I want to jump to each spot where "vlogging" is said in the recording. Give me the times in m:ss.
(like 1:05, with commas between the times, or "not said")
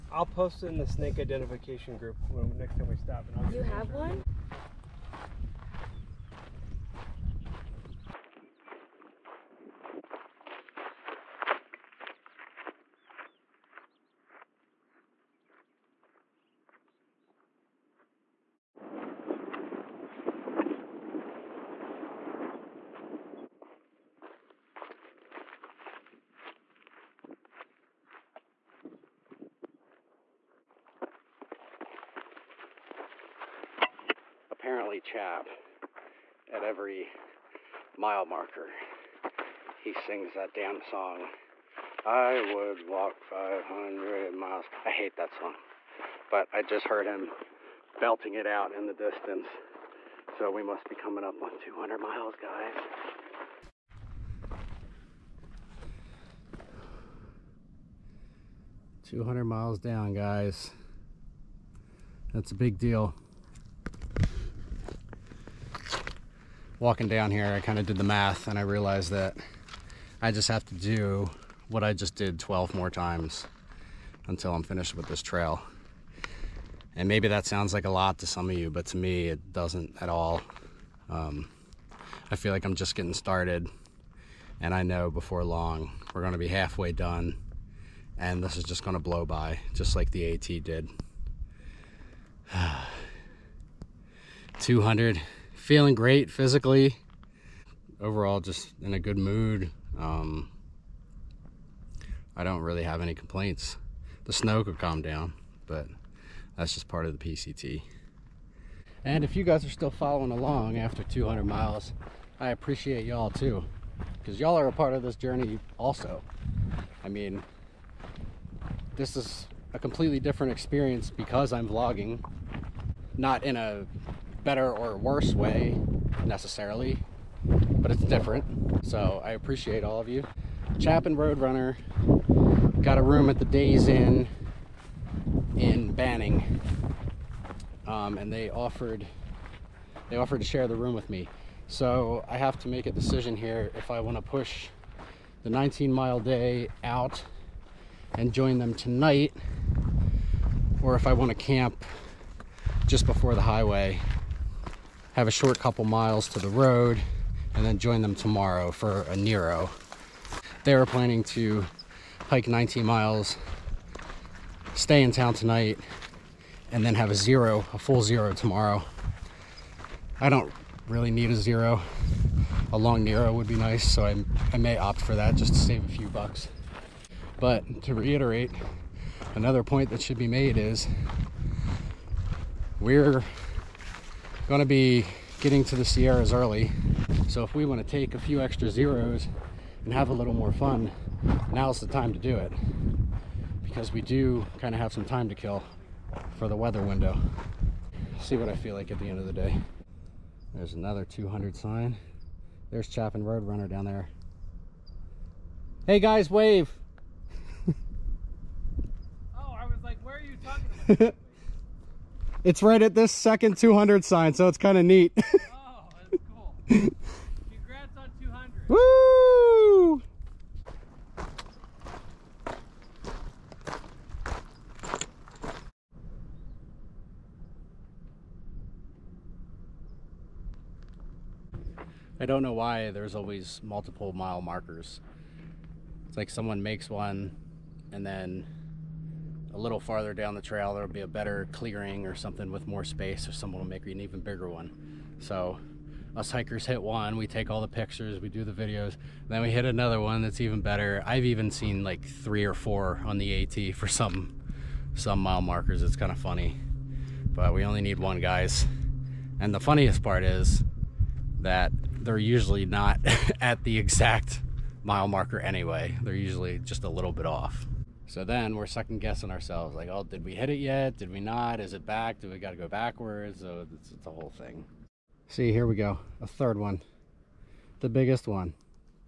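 2:01.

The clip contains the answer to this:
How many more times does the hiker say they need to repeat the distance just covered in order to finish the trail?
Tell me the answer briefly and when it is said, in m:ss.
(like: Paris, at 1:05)
12, at 1:12.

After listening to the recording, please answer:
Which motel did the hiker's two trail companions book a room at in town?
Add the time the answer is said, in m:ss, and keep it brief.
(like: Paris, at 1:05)
Days Inn, at 2:13.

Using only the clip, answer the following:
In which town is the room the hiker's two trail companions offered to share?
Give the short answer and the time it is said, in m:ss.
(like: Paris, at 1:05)
Banning, at 2:15.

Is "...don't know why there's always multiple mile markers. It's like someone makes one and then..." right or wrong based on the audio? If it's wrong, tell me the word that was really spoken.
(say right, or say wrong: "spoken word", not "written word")
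right.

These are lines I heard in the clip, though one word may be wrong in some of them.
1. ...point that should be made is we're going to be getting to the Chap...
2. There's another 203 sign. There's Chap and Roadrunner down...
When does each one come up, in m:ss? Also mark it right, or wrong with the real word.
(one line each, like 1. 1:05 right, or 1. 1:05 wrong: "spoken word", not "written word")
1. 2:59 wrong: "Sierras", not "Chap"
2. 3:20 wrong: "200", not "203".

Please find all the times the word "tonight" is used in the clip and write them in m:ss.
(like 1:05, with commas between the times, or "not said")
2:28, 2:45.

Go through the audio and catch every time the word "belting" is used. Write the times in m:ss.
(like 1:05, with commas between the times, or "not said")
0:47.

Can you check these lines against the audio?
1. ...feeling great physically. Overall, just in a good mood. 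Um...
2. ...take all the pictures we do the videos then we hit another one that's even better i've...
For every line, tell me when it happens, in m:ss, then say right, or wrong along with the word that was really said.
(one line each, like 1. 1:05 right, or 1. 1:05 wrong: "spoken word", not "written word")
1. 1:35 right
2. 4:07 right.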